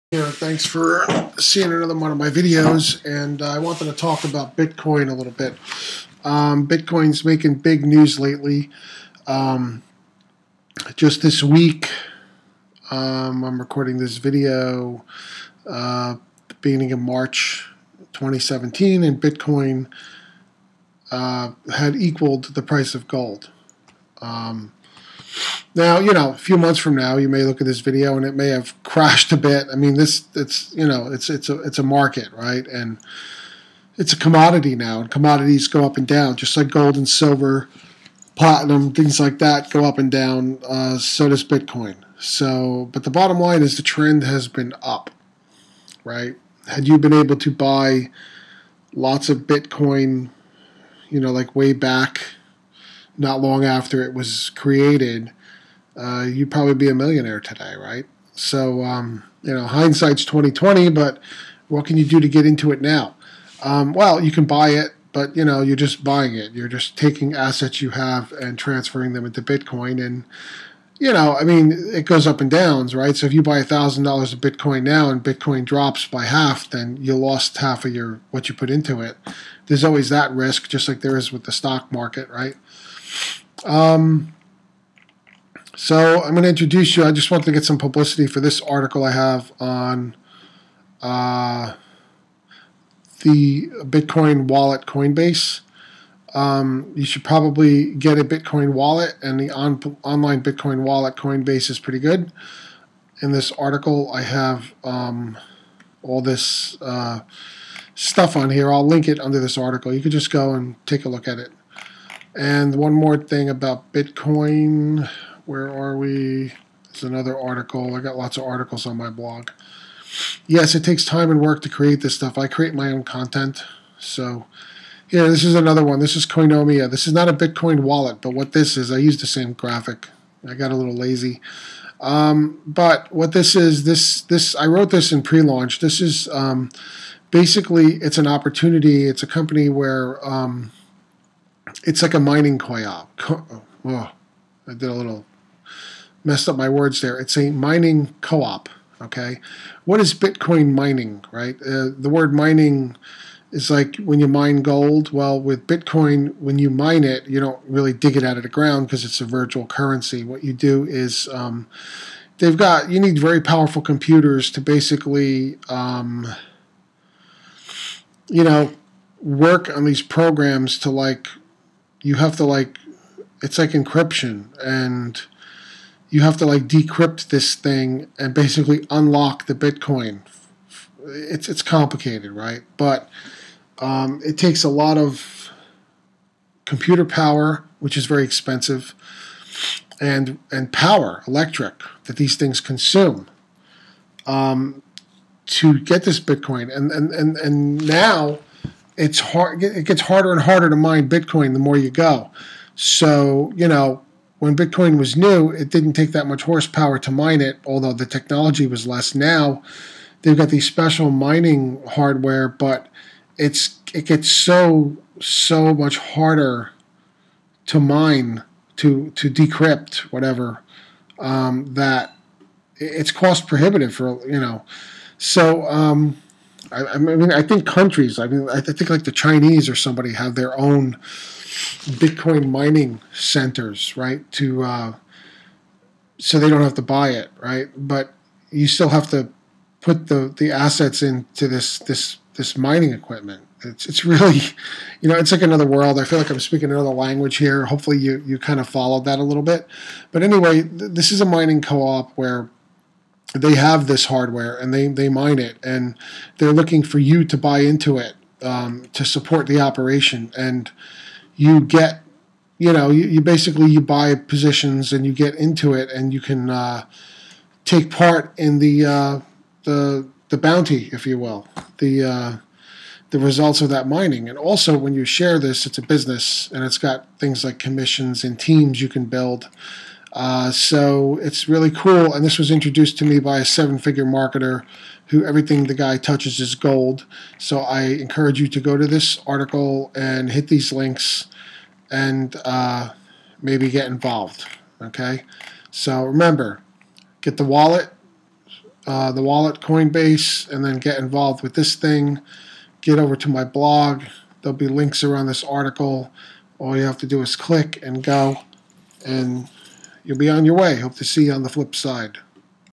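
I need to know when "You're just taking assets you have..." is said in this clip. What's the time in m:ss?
1:06.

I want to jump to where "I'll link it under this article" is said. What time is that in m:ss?
1:48.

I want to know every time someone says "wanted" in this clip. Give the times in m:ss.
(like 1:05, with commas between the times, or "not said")
0:03, 1:27.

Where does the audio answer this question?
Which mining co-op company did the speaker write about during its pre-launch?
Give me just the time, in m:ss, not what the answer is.
2:06.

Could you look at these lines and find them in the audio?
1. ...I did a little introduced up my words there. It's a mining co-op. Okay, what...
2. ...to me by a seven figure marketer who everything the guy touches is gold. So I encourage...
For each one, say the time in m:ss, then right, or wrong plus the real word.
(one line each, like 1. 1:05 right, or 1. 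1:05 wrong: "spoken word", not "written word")
1. 2:24 wrong: "messed", not "introduced"
2. 4:42 right.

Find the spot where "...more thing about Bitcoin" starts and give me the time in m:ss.
1:52.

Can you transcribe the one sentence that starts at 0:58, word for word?
So um, you know, hindsight's twenty twenty, but what can you do to get into it now?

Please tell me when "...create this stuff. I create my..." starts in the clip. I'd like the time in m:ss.
2:01.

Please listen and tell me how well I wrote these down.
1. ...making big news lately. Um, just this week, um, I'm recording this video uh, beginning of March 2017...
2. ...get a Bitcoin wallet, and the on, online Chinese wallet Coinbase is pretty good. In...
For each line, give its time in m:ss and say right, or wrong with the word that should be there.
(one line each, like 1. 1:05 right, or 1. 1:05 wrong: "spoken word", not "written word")
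1. 0:07 right
2. 1:37 wrong: "Bitcoin", not "Chinese".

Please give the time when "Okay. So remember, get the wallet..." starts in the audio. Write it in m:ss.
4:54.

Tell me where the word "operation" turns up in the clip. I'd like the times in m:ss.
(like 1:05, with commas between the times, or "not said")
4:19.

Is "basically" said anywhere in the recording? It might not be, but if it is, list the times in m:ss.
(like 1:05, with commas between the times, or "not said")
2:17, 2:44, 2:58, 4:23.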